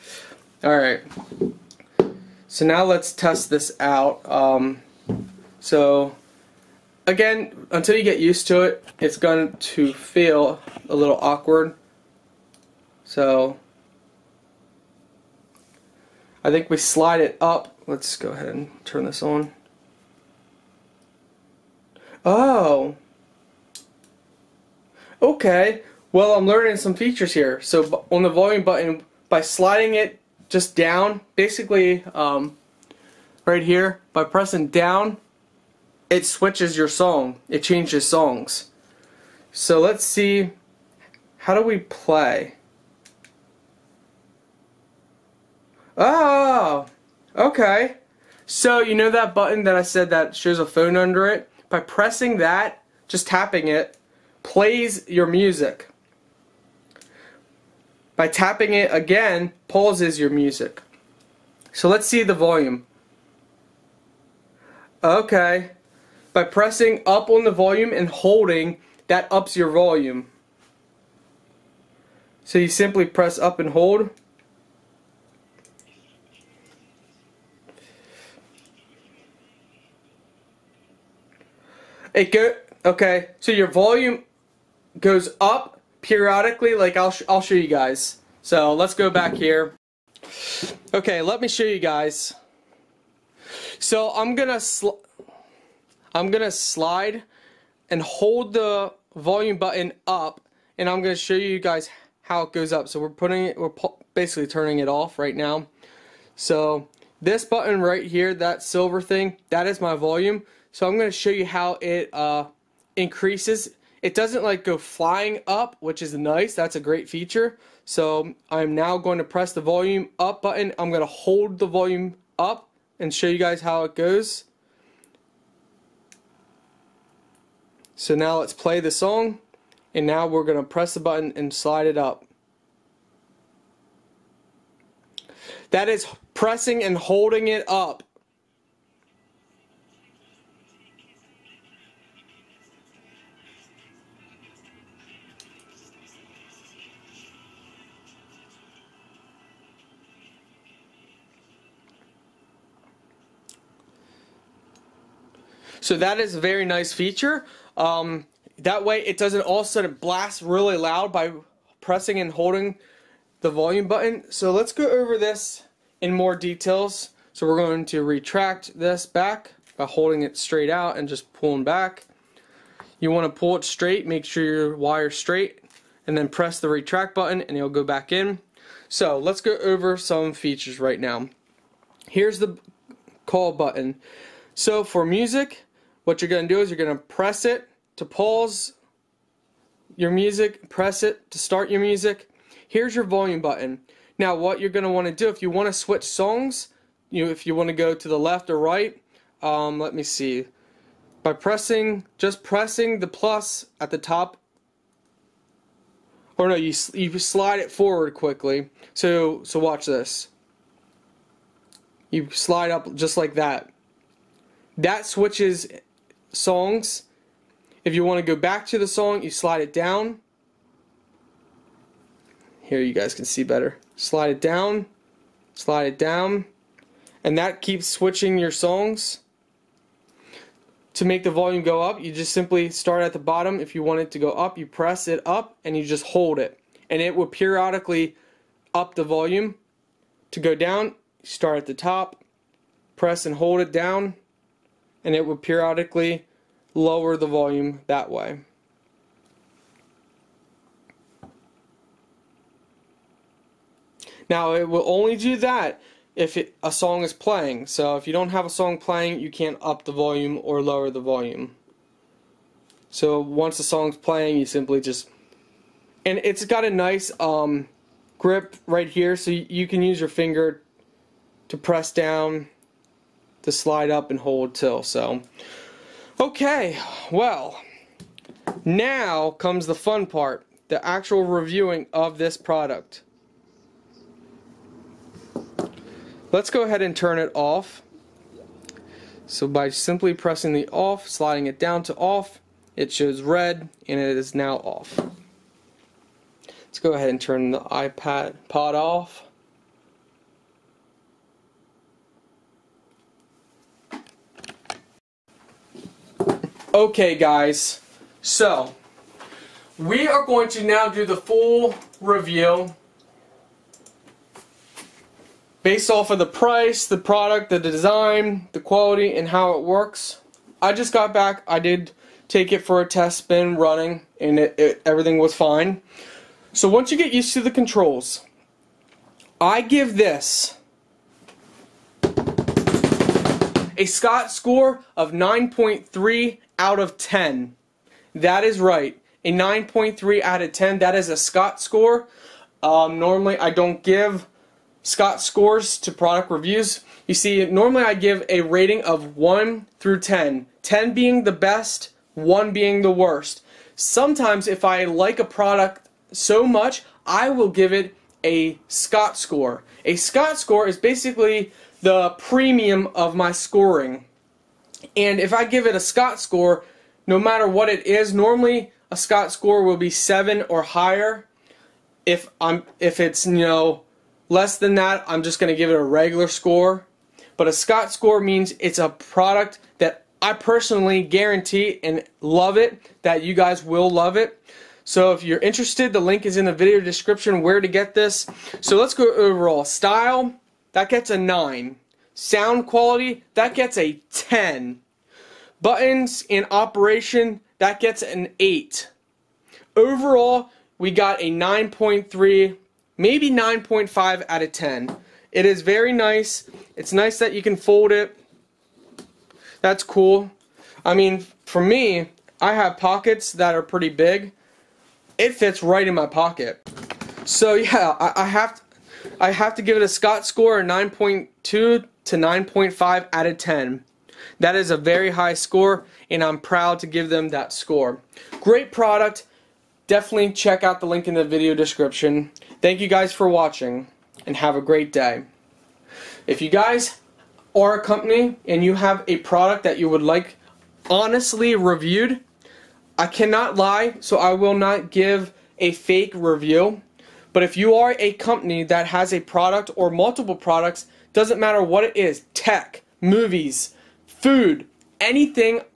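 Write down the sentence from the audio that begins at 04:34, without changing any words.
So, okay, well, now comes the fun part the actual reviewing of this product.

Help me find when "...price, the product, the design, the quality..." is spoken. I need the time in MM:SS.
05:16.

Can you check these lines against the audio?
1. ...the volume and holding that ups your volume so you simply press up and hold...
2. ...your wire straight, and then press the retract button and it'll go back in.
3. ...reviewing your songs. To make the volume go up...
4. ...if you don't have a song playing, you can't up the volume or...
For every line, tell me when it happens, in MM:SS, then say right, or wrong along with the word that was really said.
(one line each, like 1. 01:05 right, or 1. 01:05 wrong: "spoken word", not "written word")
1. 01:07 right
2. 02:54 right
3. 03:47 wrong: "switching", not "reviewing"
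4. 04:17 right.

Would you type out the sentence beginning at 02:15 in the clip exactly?
That is pressing and holding it up.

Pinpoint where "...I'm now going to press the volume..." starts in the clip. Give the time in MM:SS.
01:58.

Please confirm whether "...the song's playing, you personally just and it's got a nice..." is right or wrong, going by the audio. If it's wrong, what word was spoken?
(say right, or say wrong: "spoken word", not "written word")
wrong: "simply", not "personally".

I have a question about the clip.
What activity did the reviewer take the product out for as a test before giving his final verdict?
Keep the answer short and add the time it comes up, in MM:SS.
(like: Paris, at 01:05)
Running, at 05:23.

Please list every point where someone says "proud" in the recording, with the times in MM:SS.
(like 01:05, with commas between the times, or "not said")
07:06.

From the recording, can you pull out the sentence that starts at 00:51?
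By pressing that, just tapping it, plays your music.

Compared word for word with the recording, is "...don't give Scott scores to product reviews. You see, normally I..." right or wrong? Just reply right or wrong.
right.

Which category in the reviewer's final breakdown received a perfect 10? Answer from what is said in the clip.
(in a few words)
Sound quality.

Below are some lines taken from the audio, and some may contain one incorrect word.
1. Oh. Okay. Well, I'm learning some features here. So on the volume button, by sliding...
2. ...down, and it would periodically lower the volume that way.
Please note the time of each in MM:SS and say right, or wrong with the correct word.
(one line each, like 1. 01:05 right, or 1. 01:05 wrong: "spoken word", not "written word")
1. 00:22 right
2. 04:03 right.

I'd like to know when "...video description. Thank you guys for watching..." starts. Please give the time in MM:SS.
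07:11.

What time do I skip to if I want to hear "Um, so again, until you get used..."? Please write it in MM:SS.
00:04.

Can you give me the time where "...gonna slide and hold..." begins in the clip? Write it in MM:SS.
01:36.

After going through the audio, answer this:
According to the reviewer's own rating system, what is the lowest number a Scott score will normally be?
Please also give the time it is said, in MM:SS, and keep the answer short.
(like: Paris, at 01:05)
7, at 06:09.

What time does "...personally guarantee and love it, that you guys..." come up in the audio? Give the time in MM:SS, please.
06:20.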